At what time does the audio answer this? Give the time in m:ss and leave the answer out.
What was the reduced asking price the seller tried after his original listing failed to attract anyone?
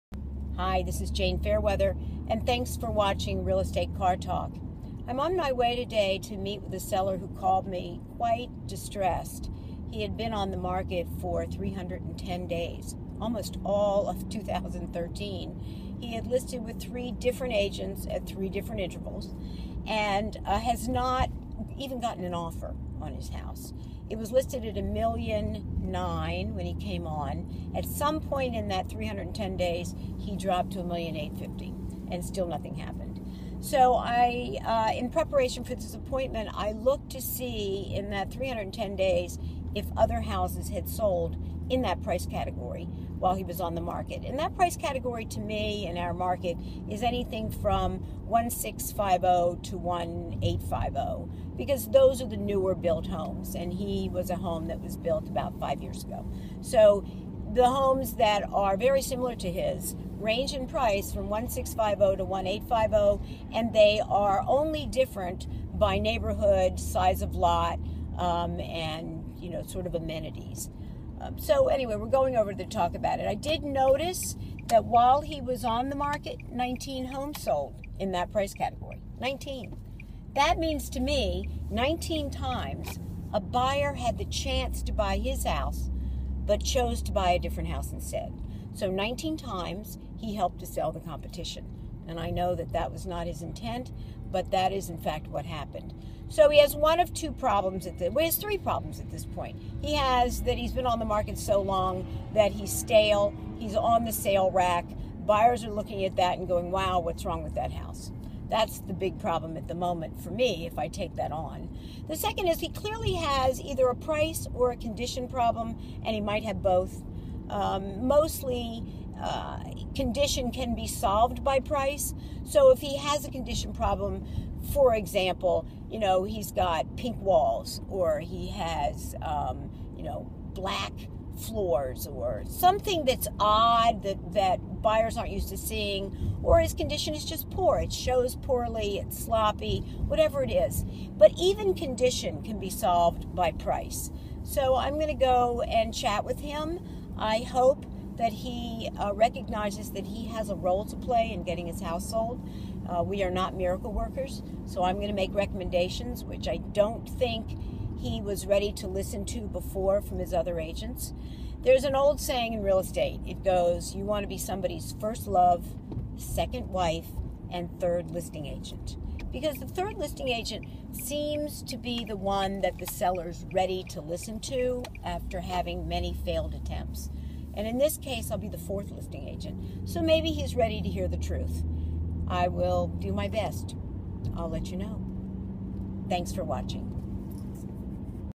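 0:30.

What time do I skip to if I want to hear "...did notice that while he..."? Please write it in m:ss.
1:13.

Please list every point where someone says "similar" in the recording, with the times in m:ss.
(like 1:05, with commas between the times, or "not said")
0:59.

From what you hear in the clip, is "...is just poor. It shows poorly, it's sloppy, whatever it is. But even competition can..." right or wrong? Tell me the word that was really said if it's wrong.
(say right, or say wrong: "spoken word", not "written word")
wrong: "condition", not "competition".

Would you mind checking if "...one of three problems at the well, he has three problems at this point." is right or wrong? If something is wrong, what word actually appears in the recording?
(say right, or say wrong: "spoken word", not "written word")
wrong: "two", not "three".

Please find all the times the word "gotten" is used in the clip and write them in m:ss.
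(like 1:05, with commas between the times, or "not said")
0:21.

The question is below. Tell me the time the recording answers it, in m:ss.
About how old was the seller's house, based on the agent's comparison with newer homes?
0:55.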